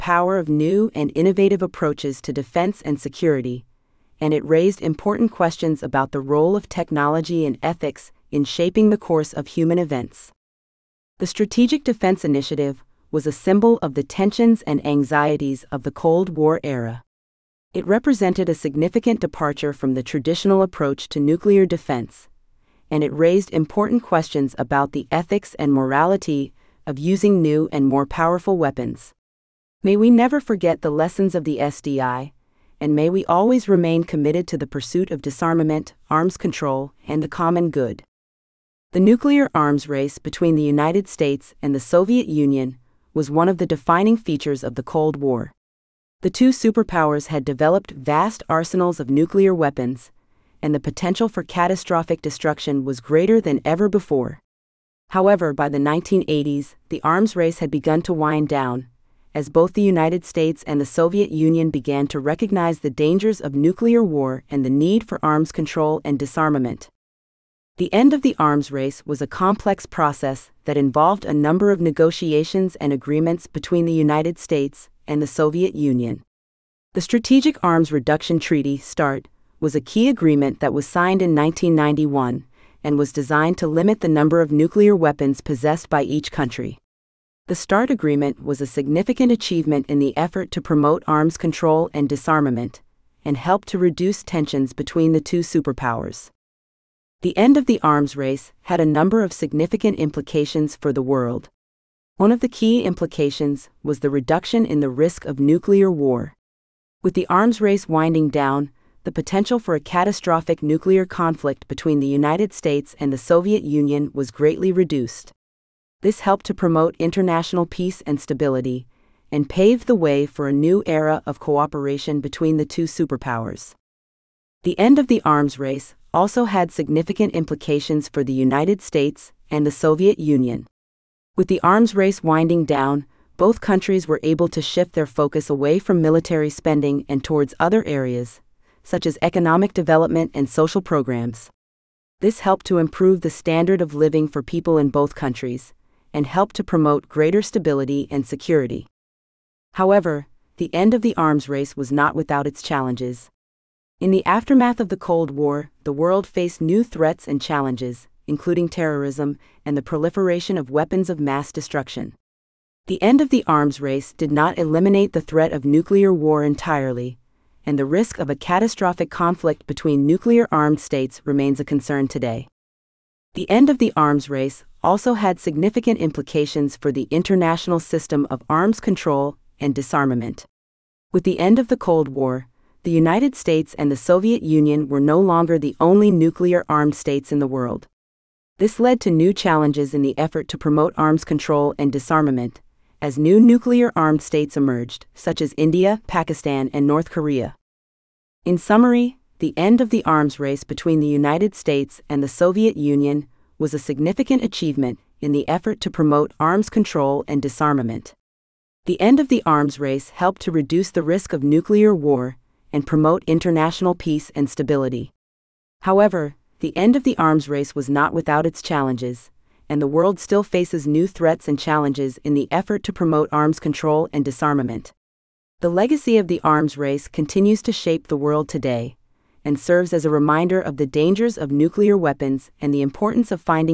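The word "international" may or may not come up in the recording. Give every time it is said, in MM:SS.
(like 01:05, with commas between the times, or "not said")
01:56, 02:57, 03:33.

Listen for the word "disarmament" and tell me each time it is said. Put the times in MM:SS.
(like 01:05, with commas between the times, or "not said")
00:35, 01:06, 01:32, 02:59, 03:11, 03:27, 03:44.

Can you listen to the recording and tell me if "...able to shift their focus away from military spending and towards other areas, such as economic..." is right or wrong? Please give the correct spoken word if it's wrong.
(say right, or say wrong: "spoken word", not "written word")
right.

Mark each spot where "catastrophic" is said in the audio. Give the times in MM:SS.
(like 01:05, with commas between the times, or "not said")
00:51, 01:49, 02:48.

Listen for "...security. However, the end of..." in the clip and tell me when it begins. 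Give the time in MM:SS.
02:28.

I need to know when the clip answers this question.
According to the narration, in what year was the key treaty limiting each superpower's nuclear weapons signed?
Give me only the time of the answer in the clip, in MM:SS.
01:21.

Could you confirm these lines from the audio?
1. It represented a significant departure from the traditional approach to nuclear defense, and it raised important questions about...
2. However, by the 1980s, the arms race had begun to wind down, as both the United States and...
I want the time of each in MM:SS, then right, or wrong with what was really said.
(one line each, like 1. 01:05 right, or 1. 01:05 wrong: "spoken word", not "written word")
1. 00:17 right
2. 00:55 right.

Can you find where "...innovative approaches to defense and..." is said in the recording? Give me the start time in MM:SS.
00:01.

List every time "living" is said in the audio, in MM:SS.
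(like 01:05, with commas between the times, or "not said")
02:23.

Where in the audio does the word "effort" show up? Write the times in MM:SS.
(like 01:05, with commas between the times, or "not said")
01:30, 03:10, 03:25, 03:42.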